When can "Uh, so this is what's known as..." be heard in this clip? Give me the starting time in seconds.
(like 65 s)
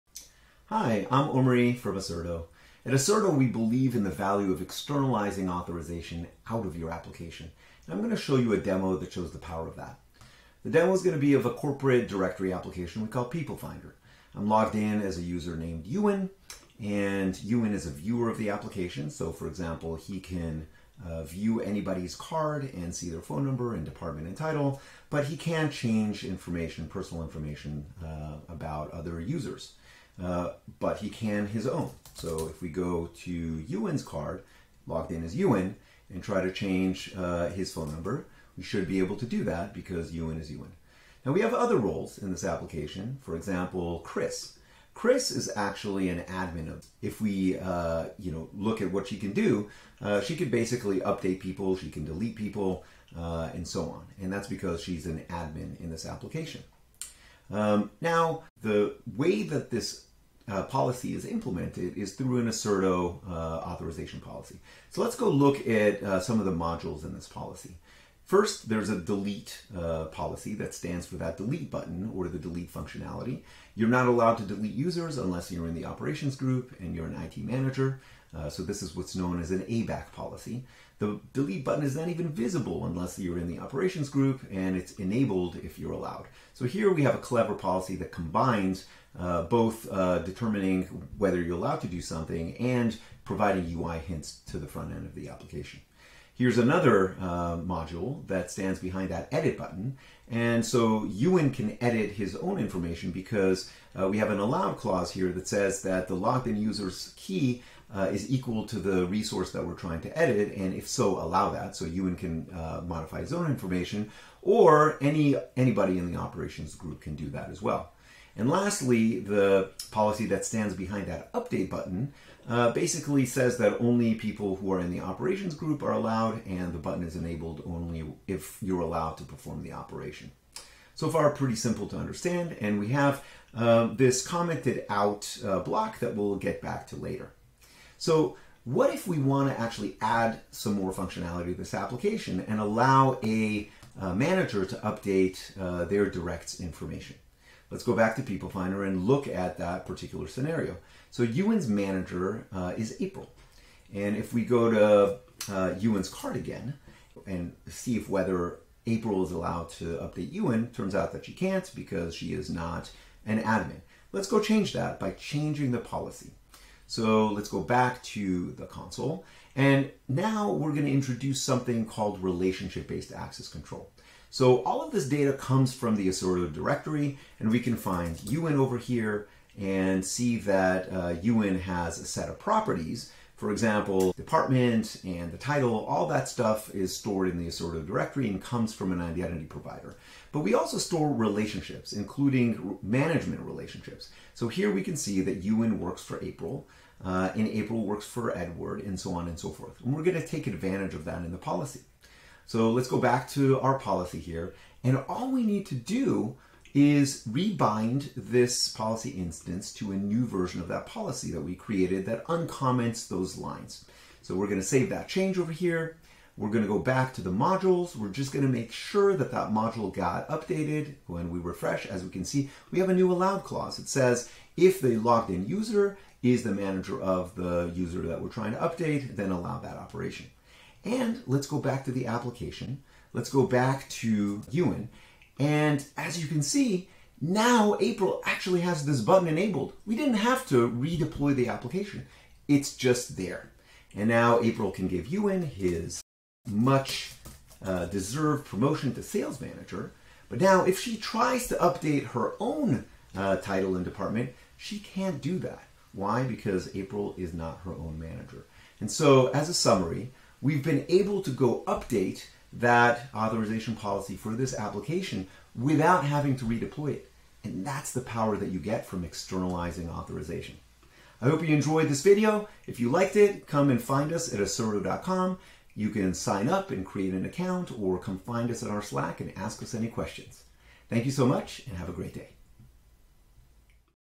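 78 s.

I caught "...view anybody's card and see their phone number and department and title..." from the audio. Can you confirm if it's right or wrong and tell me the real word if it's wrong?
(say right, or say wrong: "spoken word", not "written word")
right.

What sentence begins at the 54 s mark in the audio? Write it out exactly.
And that's because she's an admin in this application.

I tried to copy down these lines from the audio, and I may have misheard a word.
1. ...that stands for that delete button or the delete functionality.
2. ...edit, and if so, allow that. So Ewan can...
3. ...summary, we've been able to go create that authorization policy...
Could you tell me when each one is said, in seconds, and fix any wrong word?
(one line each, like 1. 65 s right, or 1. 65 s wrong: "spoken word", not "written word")
1. 70 s right
2. 110 s right
3. 259 s wrong: "update", not "create".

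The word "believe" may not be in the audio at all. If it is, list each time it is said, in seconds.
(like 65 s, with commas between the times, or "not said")
3 s.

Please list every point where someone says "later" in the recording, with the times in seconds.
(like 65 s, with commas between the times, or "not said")
136 s.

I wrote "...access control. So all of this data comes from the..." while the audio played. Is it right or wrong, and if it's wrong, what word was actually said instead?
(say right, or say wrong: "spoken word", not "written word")
right.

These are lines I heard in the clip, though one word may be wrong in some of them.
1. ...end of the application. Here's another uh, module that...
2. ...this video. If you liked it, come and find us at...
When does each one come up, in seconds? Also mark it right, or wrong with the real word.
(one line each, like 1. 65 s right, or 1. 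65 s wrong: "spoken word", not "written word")
1. 94 s right
2. 271 s right.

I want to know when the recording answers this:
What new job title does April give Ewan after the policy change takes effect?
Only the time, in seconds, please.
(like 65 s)
249 s.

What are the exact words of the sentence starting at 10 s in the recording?
The demo is going to be of a corporate directory application we call People Finder.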